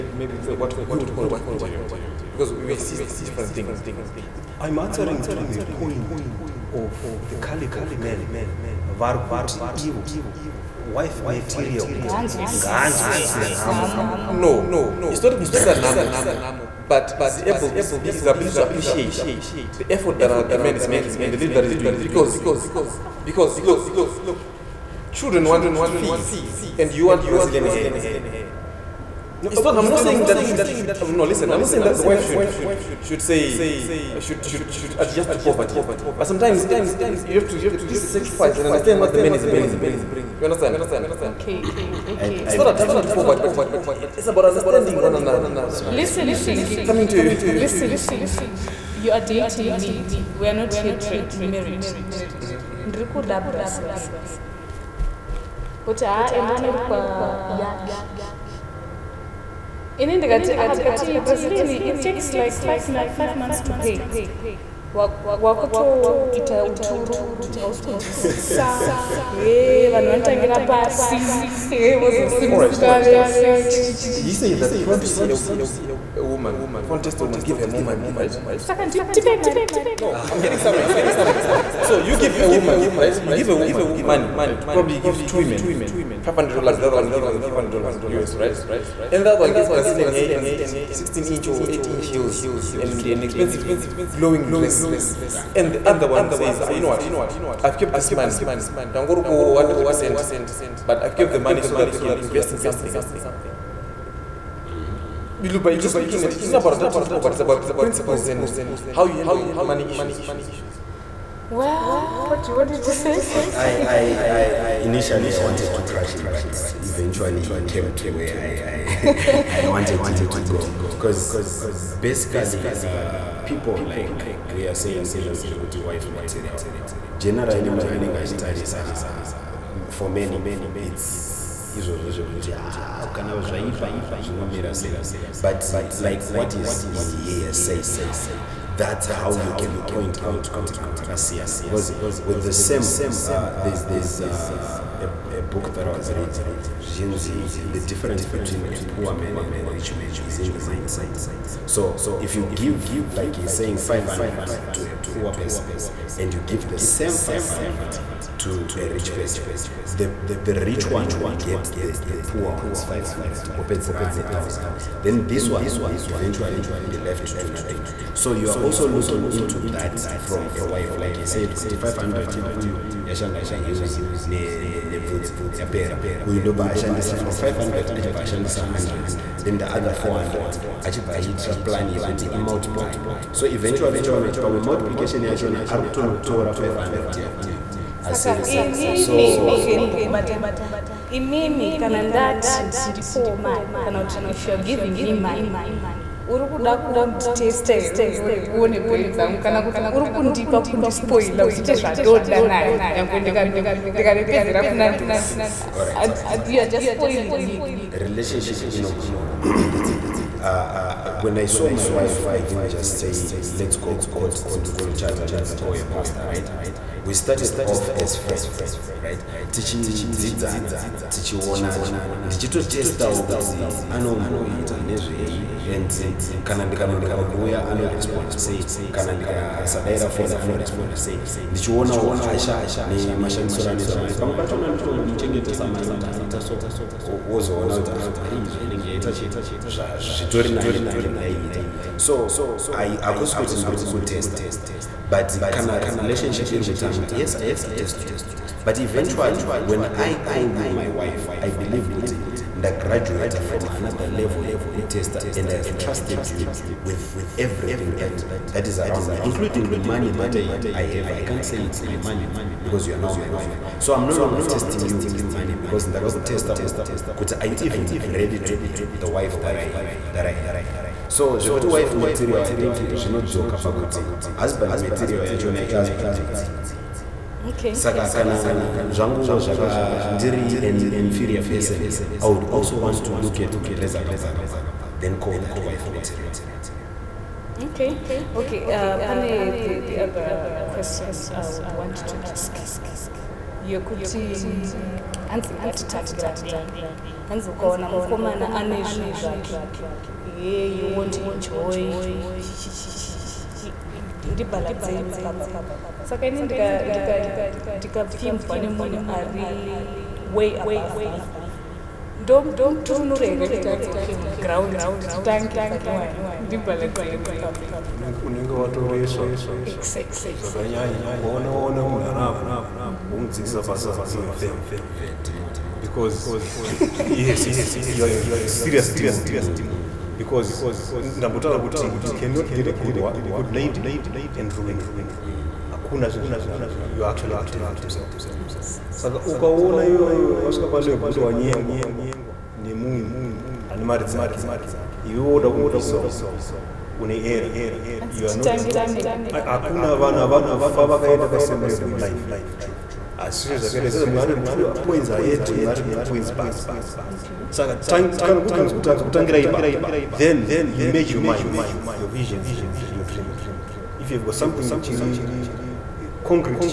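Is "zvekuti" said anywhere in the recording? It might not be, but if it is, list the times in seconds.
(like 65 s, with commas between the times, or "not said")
125 s, 132 s, 271 s.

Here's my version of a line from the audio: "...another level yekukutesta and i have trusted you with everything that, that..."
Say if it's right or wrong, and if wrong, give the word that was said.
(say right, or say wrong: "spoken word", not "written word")
right.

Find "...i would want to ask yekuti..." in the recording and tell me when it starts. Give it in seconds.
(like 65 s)
291 s.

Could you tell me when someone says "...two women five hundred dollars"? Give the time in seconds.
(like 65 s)
85 s.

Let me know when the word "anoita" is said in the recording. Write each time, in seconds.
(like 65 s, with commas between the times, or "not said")
233 s.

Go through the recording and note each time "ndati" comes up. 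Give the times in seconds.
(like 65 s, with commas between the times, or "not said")
192 s.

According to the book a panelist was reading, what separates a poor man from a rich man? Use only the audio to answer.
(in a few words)
The mindset.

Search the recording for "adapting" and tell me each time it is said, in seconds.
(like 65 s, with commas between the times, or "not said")
42 s, 106 s.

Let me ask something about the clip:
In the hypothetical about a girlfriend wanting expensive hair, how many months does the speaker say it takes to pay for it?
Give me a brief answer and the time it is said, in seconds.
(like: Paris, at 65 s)
5, at 62 s.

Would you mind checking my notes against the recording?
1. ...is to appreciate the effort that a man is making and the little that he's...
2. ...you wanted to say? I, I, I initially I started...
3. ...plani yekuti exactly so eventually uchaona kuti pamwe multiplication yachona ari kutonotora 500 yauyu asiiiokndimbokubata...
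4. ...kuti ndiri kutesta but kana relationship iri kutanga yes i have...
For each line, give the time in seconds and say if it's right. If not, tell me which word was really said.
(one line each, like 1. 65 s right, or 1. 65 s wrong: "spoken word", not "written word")
1. 18 s right
2. 112 s wrong: "wanted", not "started"
3. 181 s wrong: "imultiply", not "exactly"
4. 243 s right.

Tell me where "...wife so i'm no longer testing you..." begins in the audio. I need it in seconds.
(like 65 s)
263 s.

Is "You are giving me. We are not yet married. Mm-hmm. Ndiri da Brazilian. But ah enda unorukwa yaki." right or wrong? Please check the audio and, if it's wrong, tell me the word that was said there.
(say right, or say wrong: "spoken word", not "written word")
wrong: "dating", not "giving".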